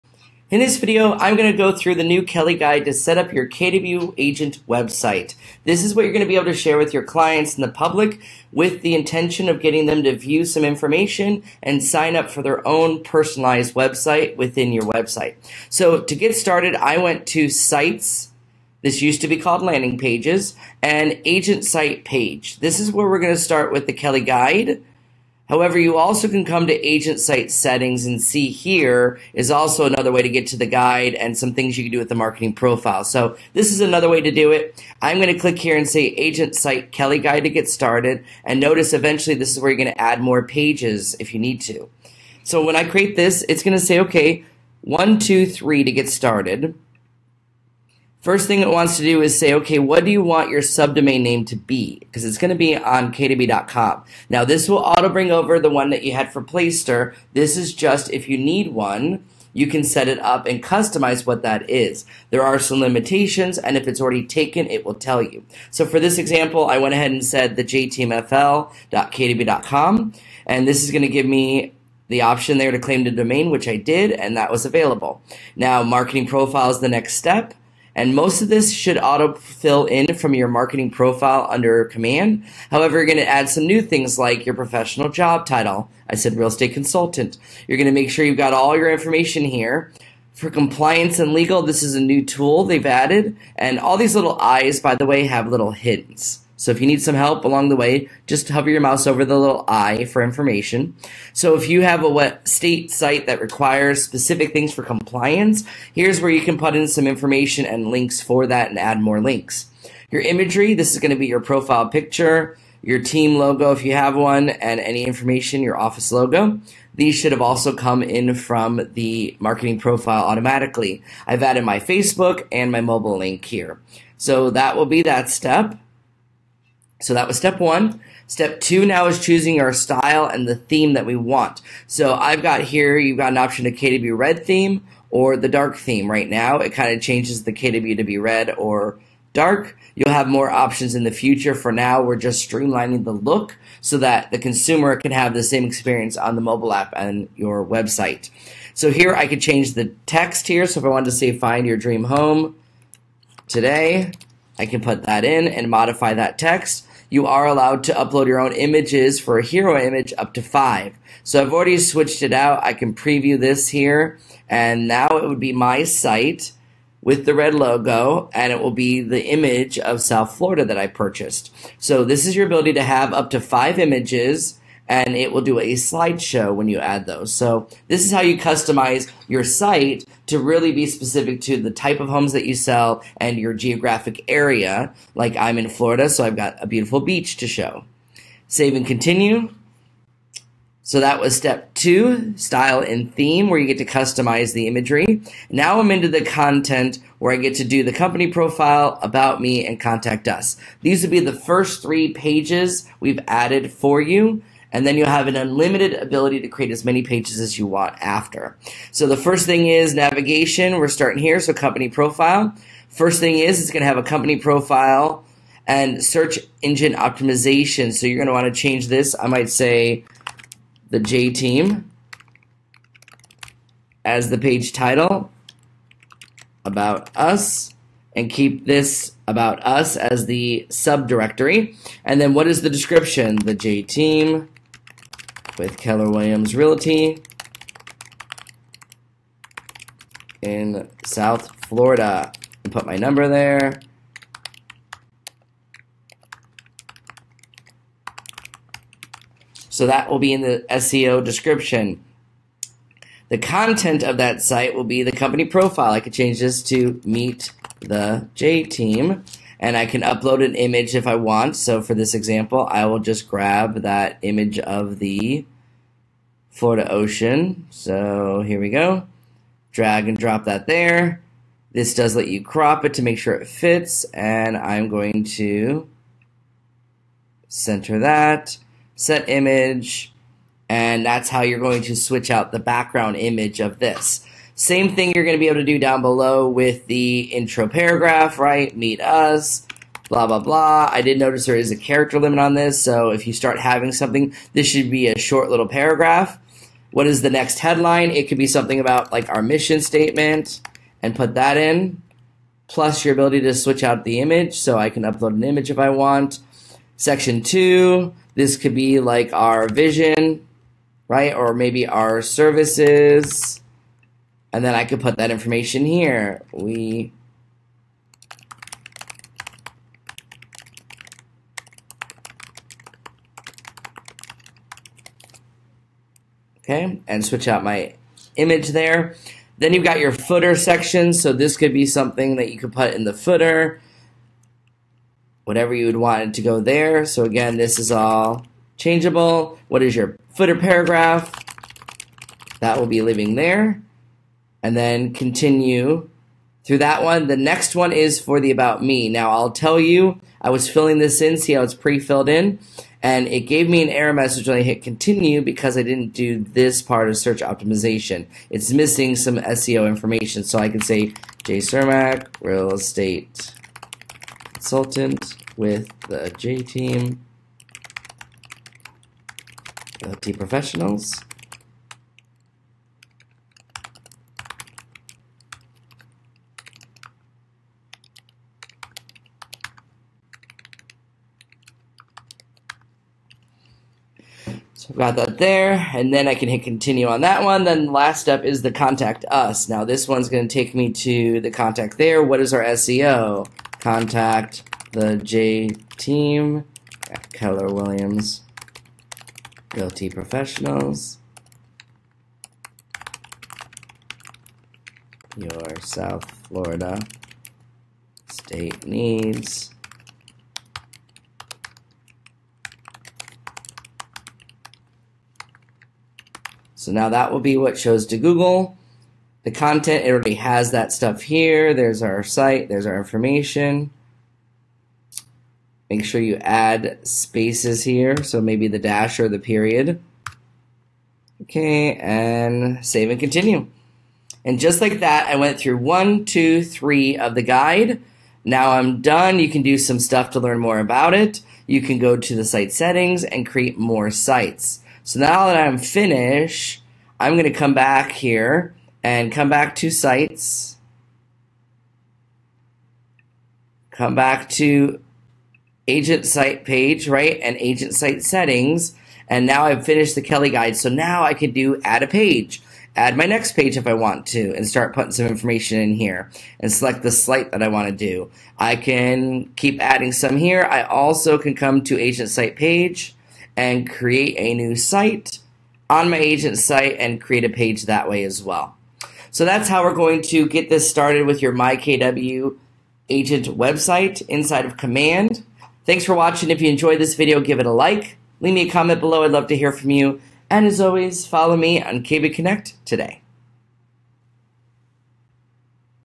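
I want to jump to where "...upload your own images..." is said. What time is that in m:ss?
2:37.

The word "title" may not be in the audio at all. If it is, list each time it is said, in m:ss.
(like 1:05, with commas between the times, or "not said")
1:25, 3:44.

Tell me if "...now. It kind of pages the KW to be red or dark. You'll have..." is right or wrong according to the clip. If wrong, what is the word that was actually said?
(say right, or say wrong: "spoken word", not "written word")
wrong: "changes", not "pages".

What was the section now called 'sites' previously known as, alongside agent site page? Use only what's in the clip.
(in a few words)
Landing pages.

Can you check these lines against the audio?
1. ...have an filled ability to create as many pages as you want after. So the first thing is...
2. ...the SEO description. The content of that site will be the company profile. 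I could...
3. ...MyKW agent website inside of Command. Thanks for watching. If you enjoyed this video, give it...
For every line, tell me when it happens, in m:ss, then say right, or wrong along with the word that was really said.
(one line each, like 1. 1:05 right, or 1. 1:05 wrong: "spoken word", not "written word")
1. 3:25 wrong: "unlimited", not "filled"
2. 4:10 right
3. 8:01 right.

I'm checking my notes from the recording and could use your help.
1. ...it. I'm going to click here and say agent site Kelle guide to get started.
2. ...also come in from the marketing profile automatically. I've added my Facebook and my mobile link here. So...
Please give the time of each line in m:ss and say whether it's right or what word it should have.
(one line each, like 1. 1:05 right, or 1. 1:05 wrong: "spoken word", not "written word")
1. 0:34 right
2. 1:57 right.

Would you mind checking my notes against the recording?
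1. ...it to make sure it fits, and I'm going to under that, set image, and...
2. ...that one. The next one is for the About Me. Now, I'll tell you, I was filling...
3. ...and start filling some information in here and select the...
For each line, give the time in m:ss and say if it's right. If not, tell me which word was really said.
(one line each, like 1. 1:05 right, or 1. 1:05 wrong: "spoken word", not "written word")
1. 4:32 wrong: "center", not "under"
2. 5:46 right
3. 7:44 wrong: "putting", not "filling".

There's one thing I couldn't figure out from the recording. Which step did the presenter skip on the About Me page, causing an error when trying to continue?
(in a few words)
Search optimization.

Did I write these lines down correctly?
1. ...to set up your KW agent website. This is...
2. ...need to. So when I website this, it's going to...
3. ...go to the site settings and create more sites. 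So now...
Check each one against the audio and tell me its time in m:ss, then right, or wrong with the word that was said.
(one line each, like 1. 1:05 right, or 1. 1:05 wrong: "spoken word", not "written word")
1. 0:02 right
2. 0:41 wrong: "create", not "website"
3. 7:21 right.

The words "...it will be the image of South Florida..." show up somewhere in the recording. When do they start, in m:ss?
2:48.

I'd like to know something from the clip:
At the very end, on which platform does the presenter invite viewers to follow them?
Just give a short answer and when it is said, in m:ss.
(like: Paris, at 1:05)
KW Connect, at 8:12.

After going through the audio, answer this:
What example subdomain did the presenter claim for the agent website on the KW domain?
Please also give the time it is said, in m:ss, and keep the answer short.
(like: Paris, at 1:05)
jtmfl.kw.com, at 1:07.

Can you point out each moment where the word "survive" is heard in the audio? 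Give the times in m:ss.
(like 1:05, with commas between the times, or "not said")
not said.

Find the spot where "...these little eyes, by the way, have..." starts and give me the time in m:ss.
1:33.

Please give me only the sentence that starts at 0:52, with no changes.
Because it's going to be on kw.com.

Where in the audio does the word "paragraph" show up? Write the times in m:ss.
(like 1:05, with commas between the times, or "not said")
4:47, 4:55, 5:40.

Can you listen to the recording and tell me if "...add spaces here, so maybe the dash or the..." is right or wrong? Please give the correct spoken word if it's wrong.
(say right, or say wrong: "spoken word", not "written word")
right.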